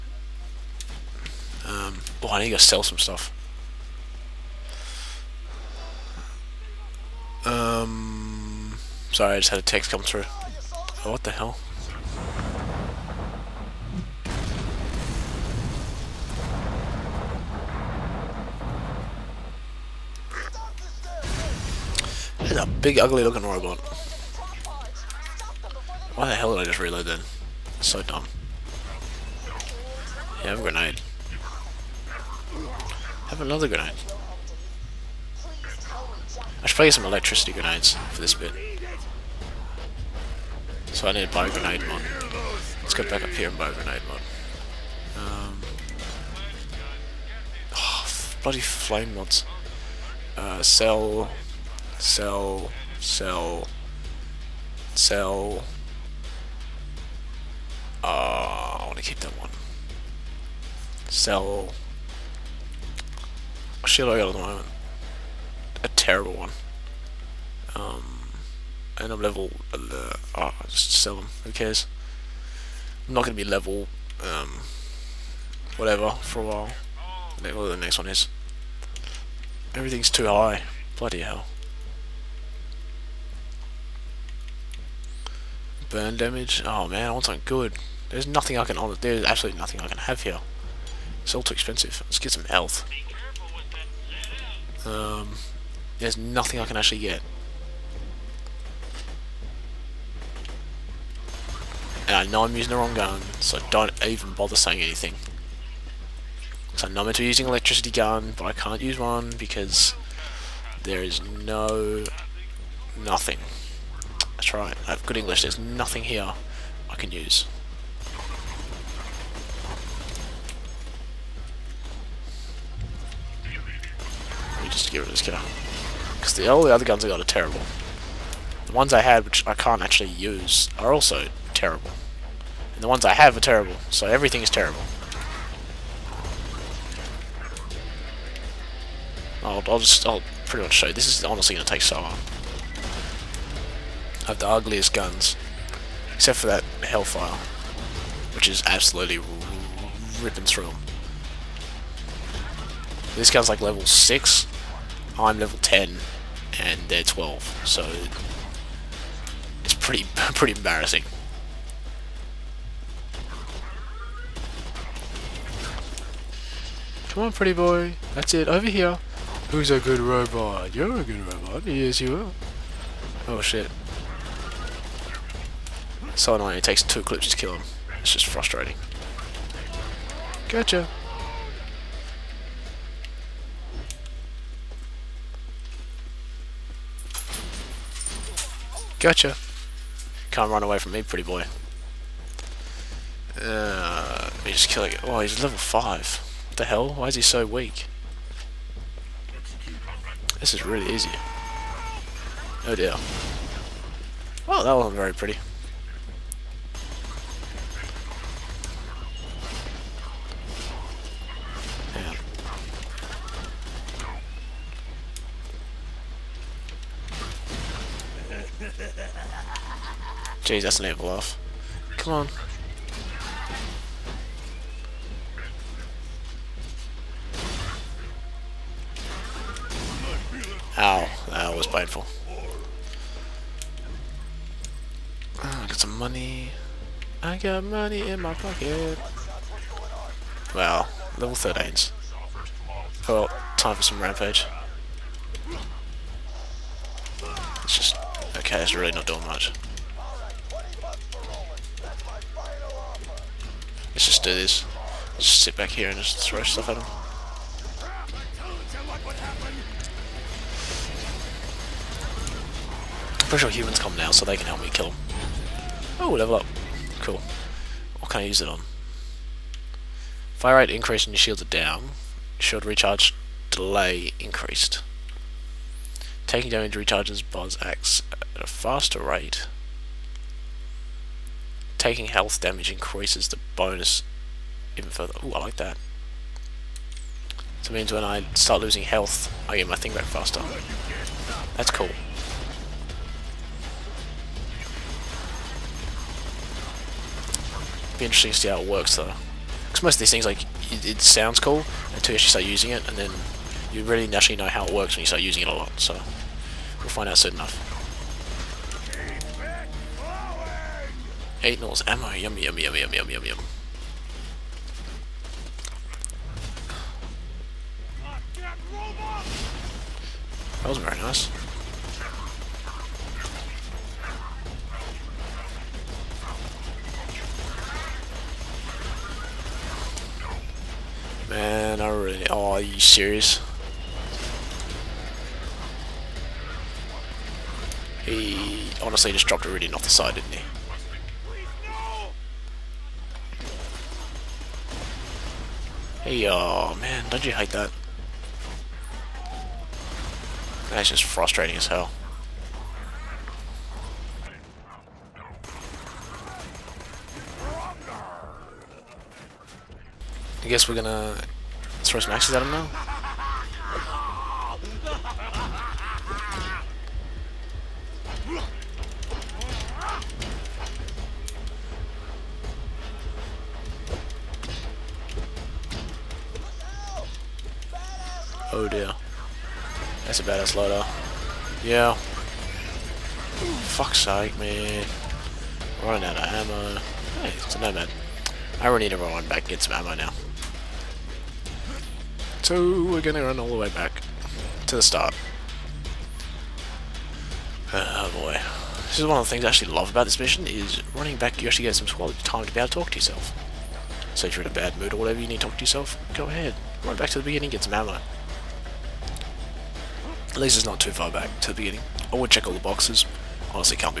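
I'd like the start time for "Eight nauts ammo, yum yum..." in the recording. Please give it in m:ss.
5:11.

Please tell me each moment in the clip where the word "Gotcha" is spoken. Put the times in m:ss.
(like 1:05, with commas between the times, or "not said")
3:00, 3:08.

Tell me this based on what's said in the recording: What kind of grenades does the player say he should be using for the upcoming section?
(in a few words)
electricity grenades.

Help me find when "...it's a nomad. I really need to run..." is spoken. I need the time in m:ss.
6:27.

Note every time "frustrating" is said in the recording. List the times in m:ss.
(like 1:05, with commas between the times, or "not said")
2:58, 5:51.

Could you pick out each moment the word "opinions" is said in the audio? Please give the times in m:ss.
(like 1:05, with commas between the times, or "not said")
not said.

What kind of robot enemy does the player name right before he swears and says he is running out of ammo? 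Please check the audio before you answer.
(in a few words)
badass loader.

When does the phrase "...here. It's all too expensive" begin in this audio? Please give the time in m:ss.
1:30.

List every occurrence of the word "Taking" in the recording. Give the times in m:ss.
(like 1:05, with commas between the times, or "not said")
4:36, 4:41.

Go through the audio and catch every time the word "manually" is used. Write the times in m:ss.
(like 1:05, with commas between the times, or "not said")
not said.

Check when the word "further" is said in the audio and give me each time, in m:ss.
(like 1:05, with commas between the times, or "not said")
4:44.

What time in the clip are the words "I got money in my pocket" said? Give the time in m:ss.
3:57.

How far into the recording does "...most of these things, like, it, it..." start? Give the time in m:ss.
4:59.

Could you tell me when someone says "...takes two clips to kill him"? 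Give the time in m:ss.
2:56.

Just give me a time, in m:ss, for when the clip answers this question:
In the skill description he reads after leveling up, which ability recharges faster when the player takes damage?
4:37.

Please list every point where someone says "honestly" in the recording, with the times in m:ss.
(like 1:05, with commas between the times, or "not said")
2:21, 5:38.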